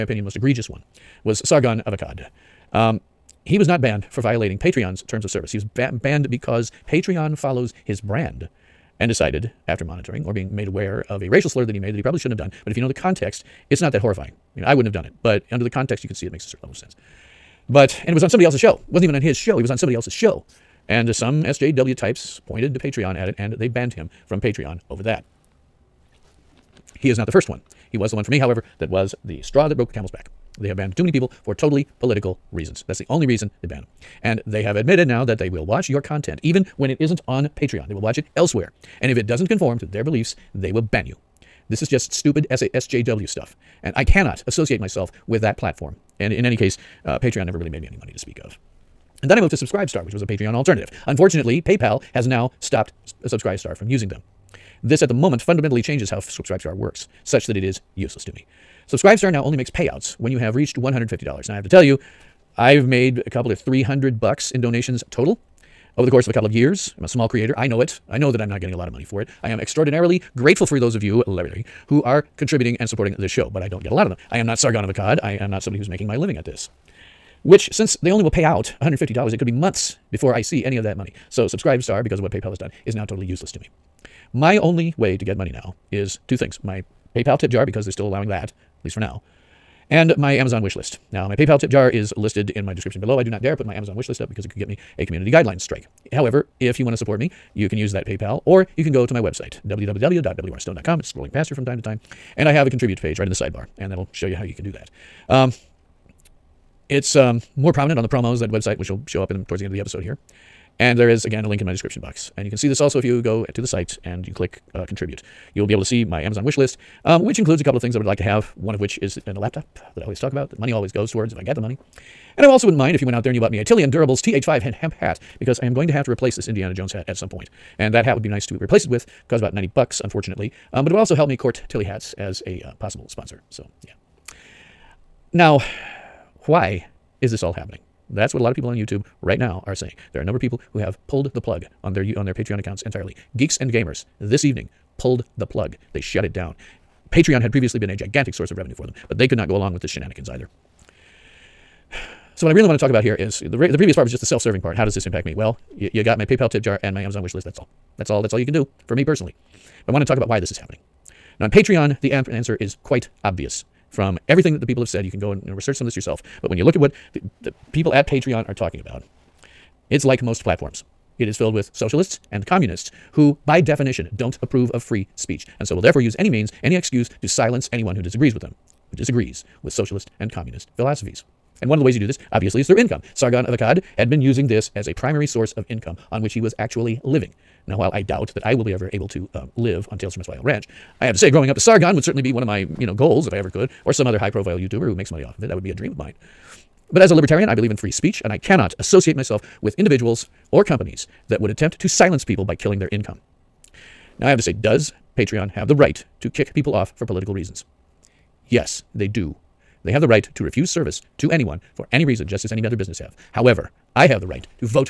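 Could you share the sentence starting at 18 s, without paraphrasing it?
It wasn't even on his show.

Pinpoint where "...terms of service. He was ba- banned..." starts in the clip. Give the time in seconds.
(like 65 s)
5 s.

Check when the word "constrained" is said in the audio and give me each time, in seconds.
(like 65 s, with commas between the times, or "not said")
not said.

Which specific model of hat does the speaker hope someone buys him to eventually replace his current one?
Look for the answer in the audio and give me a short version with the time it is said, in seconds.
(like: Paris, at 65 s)
Tilley Endurables TH5, at 123 s.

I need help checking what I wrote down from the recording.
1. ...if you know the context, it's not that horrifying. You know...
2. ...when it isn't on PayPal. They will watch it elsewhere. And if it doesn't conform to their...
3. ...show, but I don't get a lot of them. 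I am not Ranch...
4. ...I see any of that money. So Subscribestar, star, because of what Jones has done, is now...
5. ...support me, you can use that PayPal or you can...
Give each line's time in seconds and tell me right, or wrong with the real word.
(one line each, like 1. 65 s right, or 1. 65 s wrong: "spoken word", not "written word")
1. 12 s right
2. 36 s wrong: "Patreon", not "PayPal"
3. 73 s wrong: "Sargon", not "Ranch"
4. 80 s wrong: "PayPal", not "Jones"
5. 96 s right.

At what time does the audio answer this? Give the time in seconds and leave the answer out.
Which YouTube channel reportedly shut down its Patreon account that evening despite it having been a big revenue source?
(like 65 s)
143 s.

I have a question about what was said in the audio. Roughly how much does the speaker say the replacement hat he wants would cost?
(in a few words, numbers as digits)
$90.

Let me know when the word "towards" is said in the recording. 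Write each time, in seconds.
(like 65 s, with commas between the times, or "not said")
109 s, 121 s.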